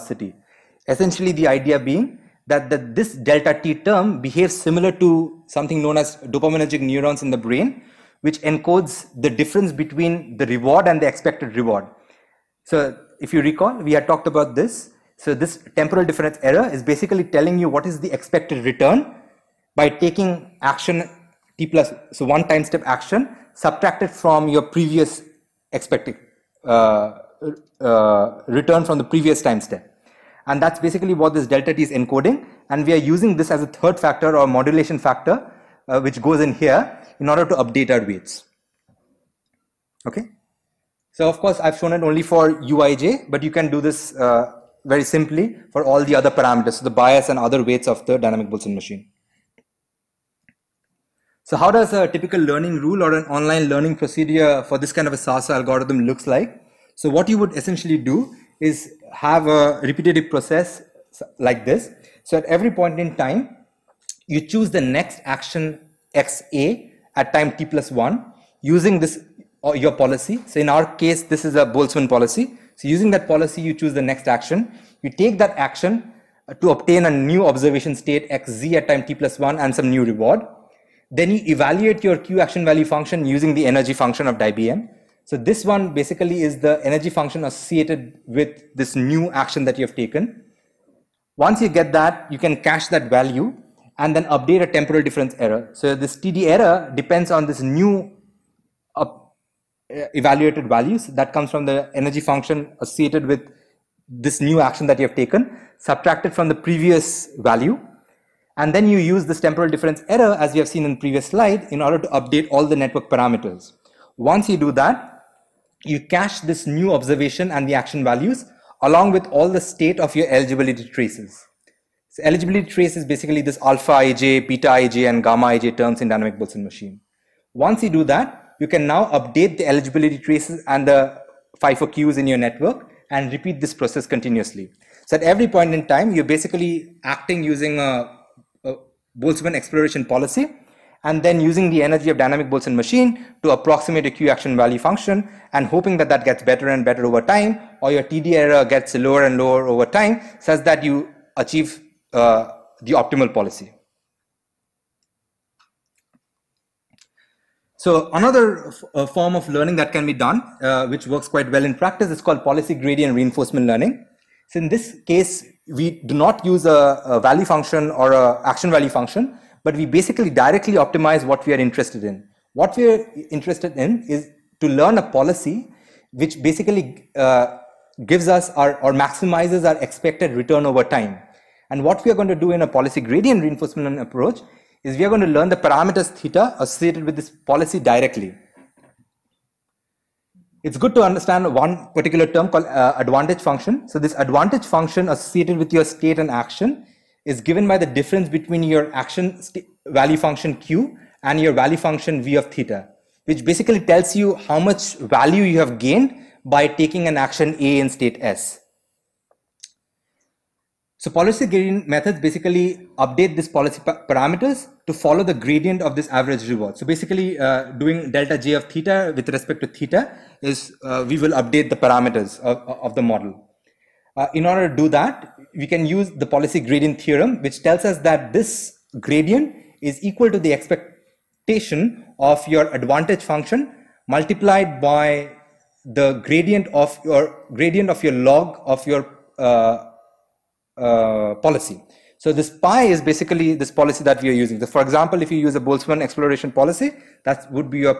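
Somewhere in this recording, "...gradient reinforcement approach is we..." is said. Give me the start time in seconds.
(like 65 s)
183 s.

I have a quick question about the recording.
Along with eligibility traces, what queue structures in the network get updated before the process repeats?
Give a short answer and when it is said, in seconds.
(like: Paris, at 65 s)
FIFO queues, at 131 s.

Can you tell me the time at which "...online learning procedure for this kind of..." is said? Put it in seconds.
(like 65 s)
53 s.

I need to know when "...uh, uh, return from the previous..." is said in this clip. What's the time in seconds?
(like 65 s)
26 s.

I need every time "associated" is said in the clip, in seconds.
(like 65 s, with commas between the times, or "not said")
87 s, 102 s, 186 s, 195 s.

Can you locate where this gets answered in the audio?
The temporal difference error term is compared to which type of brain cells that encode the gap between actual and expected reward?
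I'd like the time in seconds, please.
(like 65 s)
6 s.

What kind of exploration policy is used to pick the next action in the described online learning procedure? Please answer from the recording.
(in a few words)
Boltzmann policy.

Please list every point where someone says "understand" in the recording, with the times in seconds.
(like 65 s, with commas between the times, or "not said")
191 s.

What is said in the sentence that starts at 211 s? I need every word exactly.
So policy gradient methods basically update these policy pa parameters to follow the gradient of this average reward.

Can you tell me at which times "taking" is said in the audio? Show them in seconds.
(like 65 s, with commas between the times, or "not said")
19 s, 206 s.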